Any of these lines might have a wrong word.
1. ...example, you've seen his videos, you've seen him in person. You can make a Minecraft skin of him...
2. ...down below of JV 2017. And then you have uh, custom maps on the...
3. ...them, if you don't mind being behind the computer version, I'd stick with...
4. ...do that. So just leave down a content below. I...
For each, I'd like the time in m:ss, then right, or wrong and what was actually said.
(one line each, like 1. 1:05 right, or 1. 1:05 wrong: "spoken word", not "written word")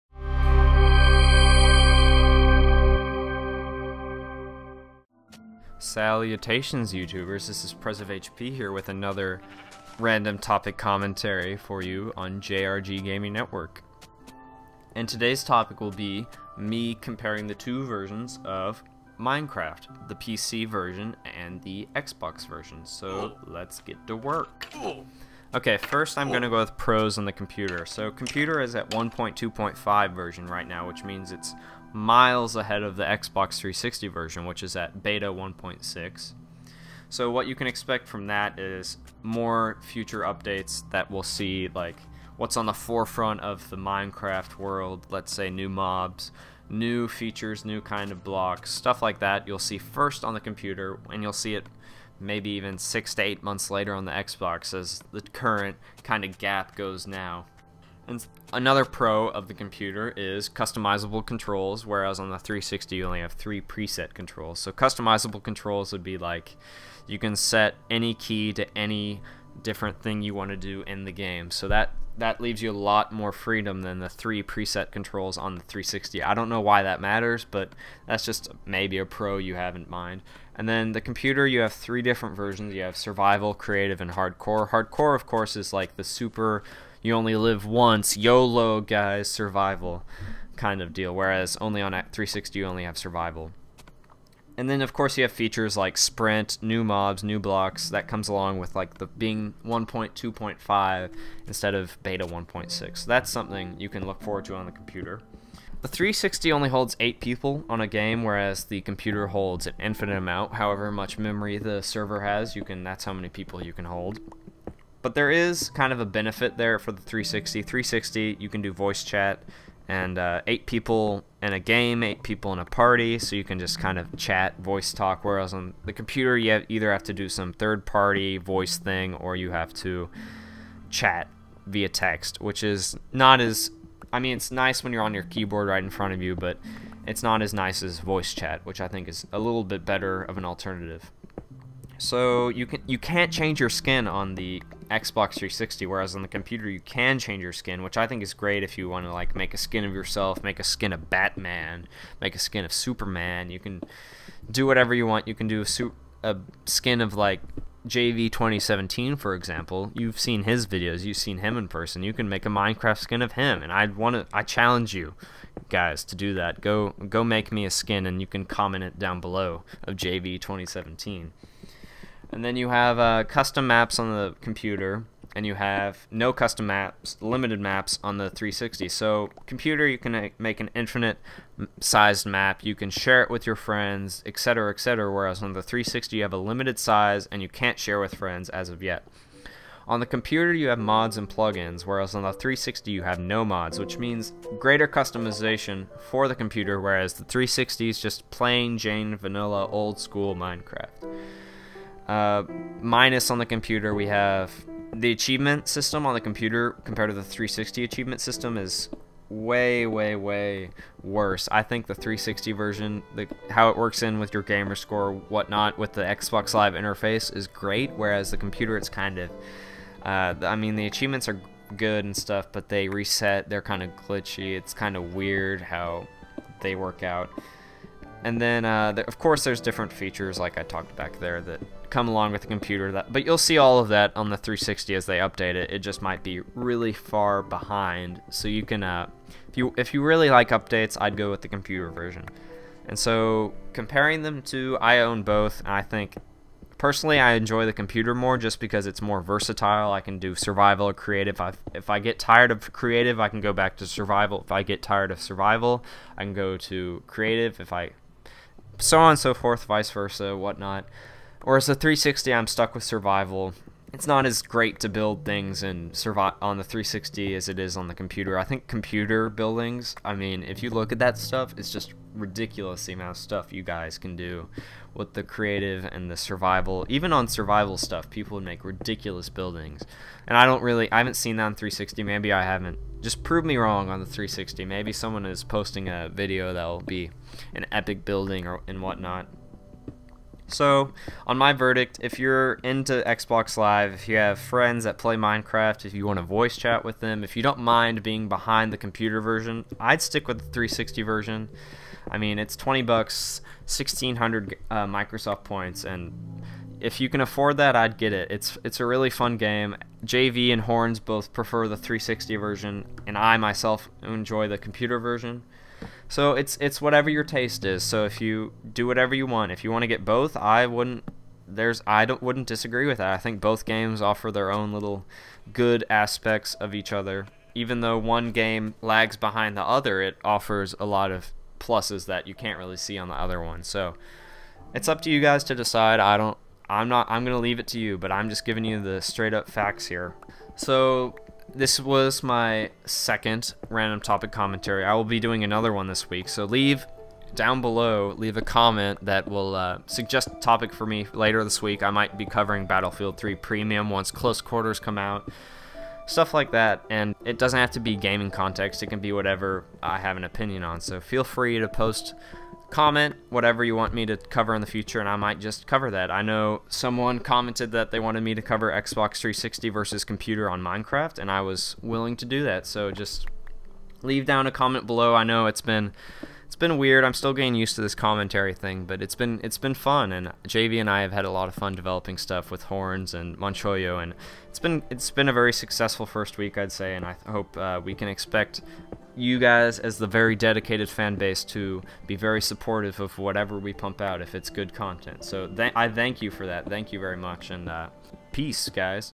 1. 2:39 right
2. 2:48 right
3. 4:56 right
4. 6:12 wrong: "comment", not "content".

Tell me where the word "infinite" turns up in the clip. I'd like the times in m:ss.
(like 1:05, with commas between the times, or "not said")
1:49, 3:00.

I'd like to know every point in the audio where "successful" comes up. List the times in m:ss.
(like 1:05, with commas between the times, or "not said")
6:25.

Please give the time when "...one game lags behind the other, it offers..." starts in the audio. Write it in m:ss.
5:27.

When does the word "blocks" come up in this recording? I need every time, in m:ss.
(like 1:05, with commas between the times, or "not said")
0:48, 1:37.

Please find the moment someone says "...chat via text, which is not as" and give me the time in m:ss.
2:10.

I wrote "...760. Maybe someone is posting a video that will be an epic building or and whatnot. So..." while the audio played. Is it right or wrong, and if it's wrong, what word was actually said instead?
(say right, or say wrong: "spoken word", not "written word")
wrong: "360", not "760".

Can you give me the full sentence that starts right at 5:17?
So if you do whatever you want, if you want to get both, I wouldn't.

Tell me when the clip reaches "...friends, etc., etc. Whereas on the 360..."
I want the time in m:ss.
3:03.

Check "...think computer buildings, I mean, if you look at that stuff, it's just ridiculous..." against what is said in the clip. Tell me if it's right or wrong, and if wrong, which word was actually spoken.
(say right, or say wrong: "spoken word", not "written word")
right.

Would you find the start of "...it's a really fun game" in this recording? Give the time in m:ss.
5:08.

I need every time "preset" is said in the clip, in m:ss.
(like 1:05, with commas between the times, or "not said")
1:03, 1:14.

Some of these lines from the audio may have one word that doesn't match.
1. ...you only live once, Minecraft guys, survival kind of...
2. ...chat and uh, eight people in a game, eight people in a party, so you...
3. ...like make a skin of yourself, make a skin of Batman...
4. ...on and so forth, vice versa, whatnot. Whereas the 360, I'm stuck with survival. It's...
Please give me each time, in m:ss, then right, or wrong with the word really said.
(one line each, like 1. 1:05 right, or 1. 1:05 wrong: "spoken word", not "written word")
1. 1:27 wrong: "YOLO", not "Minecraft"
2. 1:59 right
3. 2:29 right
4. 4:18 right.